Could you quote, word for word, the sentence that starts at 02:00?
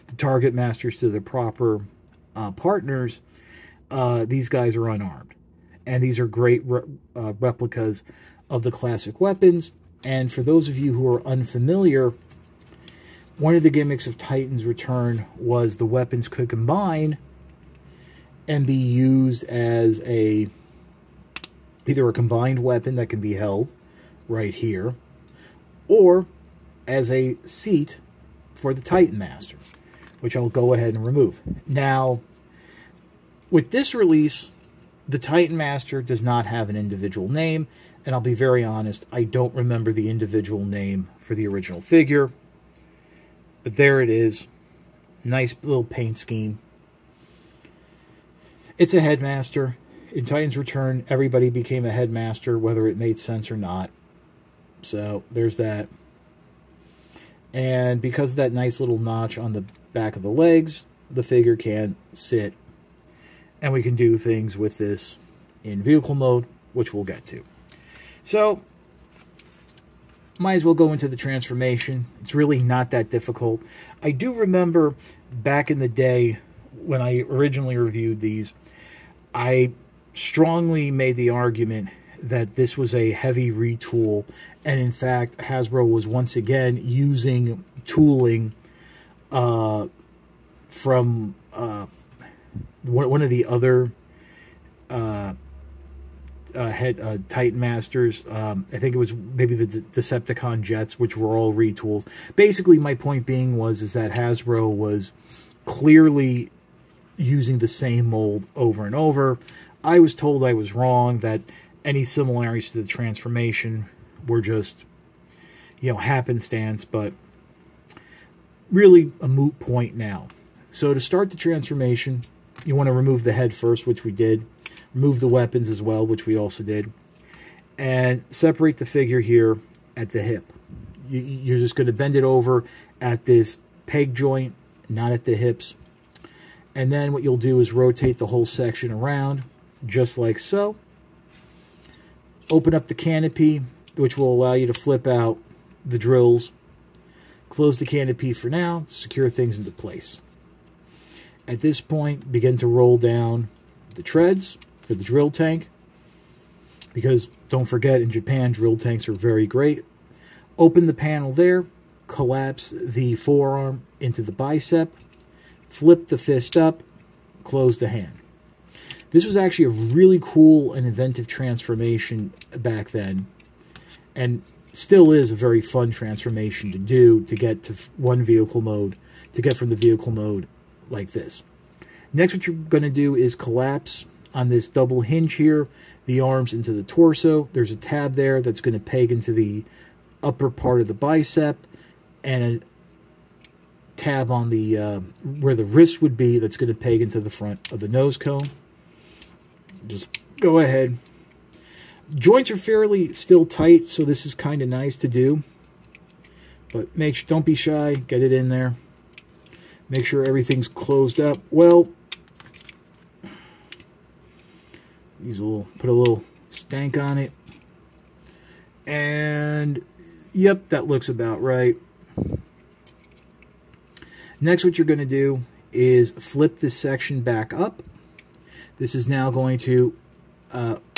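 So to start the transformation, you want to remove the head first, which we did.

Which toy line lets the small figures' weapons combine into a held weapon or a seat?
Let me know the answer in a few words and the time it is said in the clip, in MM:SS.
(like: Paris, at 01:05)
Titans Return, at 00:14.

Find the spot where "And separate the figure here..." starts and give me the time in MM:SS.
02:07.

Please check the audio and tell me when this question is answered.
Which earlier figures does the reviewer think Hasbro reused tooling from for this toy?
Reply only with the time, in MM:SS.
01:39.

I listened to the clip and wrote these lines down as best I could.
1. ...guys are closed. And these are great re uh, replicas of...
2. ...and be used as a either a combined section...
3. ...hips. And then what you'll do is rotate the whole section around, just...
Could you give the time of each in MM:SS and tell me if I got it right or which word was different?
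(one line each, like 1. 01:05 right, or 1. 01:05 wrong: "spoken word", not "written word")
1. 00:04 wrong: "unarmed", not "closed"
2. 00:18 wrong: "weapon", not "section"
3. 02:15 right.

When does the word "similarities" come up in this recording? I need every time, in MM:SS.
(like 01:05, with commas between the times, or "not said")
01:52.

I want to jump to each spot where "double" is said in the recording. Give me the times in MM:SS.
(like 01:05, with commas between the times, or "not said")
03:04.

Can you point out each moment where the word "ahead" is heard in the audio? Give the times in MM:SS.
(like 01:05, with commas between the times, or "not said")
00:30, 03:20.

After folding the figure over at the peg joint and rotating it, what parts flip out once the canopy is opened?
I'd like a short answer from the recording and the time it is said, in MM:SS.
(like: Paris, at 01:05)
the drills, at 02:25.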